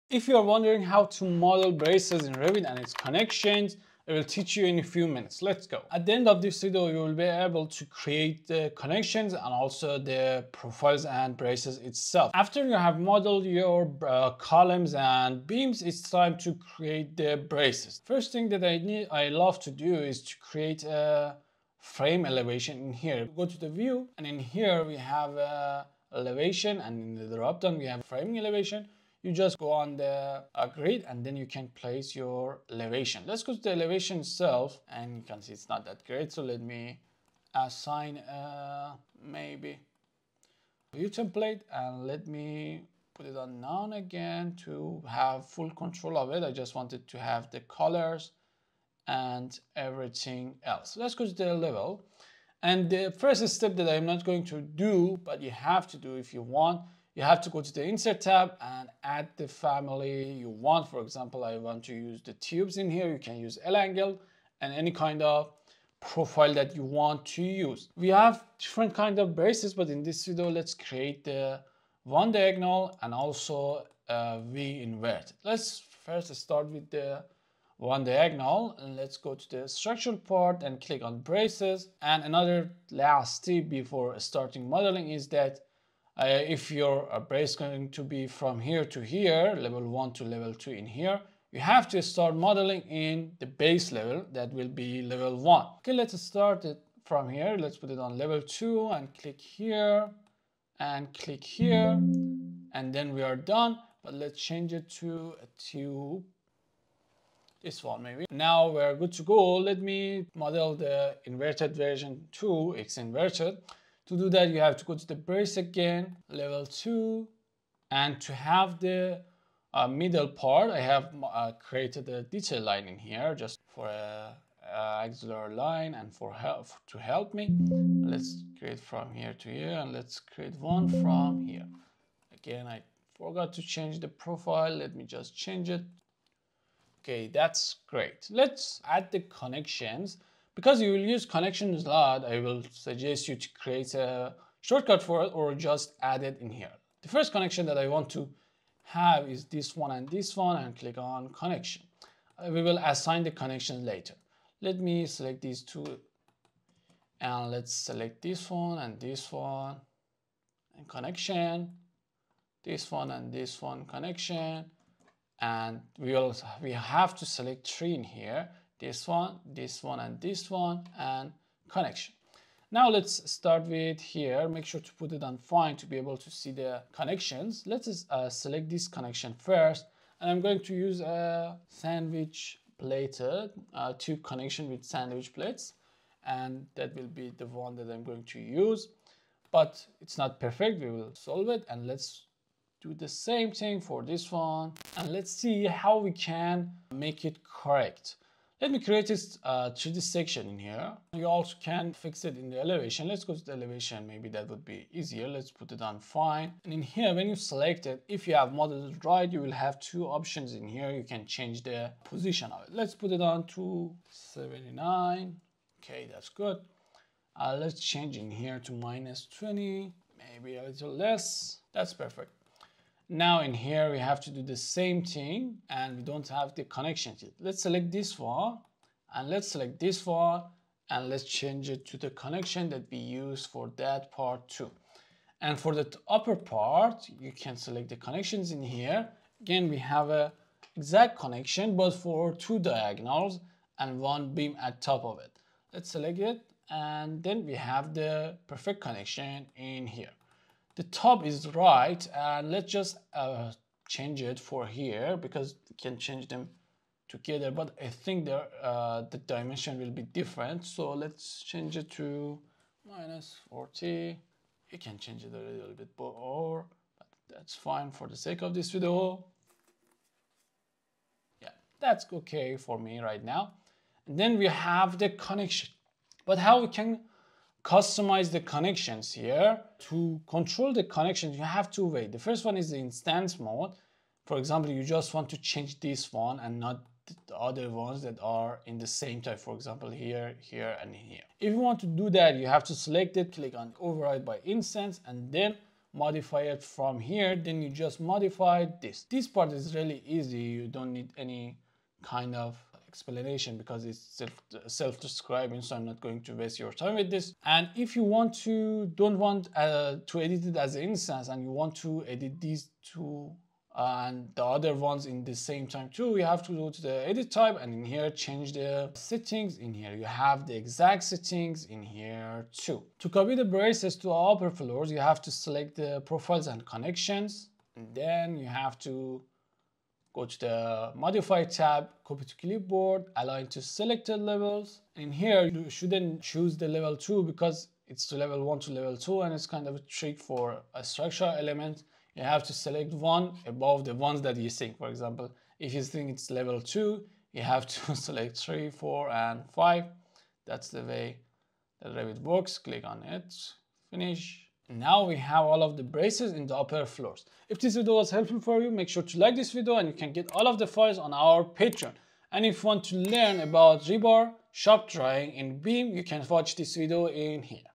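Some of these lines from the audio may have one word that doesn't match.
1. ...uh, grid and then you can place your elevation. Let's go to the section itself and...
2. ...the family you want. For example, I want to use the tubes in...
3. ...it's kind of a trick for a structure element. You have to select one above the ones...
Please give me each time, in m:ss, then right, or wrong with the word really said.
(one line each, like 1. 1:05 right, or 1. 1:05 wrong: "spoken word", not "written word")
1. 0:30 wrong: "elevation", not "section"
2. 0:59 right
3. 5:39 right.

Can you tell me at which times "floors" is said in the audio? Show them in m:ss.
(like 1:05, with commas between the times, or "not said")
5:24, 5:56.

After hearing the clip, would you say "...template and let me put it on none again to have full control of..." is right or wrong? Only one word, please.
right.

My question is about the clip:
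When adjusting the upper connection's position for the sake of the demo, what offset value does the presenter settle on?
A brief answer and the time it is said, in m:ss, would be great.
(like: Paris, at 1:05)
-40, at 4:22.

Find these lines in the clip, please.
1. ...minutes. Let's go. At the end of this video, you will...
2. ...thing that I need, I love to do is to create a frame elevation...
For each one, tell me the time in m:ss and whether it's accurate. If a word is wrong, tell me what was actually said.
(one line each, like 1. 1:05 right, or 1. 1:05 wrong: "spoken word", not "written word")
1. 0:05 right
2. 0:18 right.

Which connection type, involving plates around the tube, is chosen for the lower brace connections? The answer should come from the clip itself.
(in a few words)
Sandwich plates.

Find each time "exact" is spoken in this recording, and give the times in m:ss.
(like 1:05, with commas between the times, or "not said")
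4:00, 5:20.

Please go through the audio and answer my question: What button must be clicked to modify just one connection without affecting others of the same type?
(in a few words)
Override by instance.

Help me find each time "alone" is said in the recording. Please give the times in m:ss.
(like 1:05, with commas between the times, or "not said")
not said.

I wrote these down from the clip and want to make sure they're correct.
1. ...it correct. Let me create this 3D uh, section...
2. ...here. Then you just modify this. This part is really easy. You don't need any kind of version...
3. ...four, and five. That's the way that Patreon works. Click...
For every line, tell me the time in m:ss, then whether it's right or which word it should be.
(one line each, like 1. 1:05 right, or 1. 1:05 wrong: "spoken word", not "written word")
1. 3:17 right
2. 4:56 wrong: "explanation", not "version"
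3. 5:48 wrong: "Revit", not "Patreon".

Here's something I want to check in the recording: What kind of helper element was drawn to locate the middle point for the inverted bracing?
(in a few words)
Detail line.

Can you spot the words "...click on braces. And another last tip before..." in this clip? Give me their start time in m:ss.
1:20.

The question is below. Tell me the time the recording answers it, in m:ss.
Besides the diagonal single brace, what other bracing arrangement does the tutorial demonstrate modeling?
1:14.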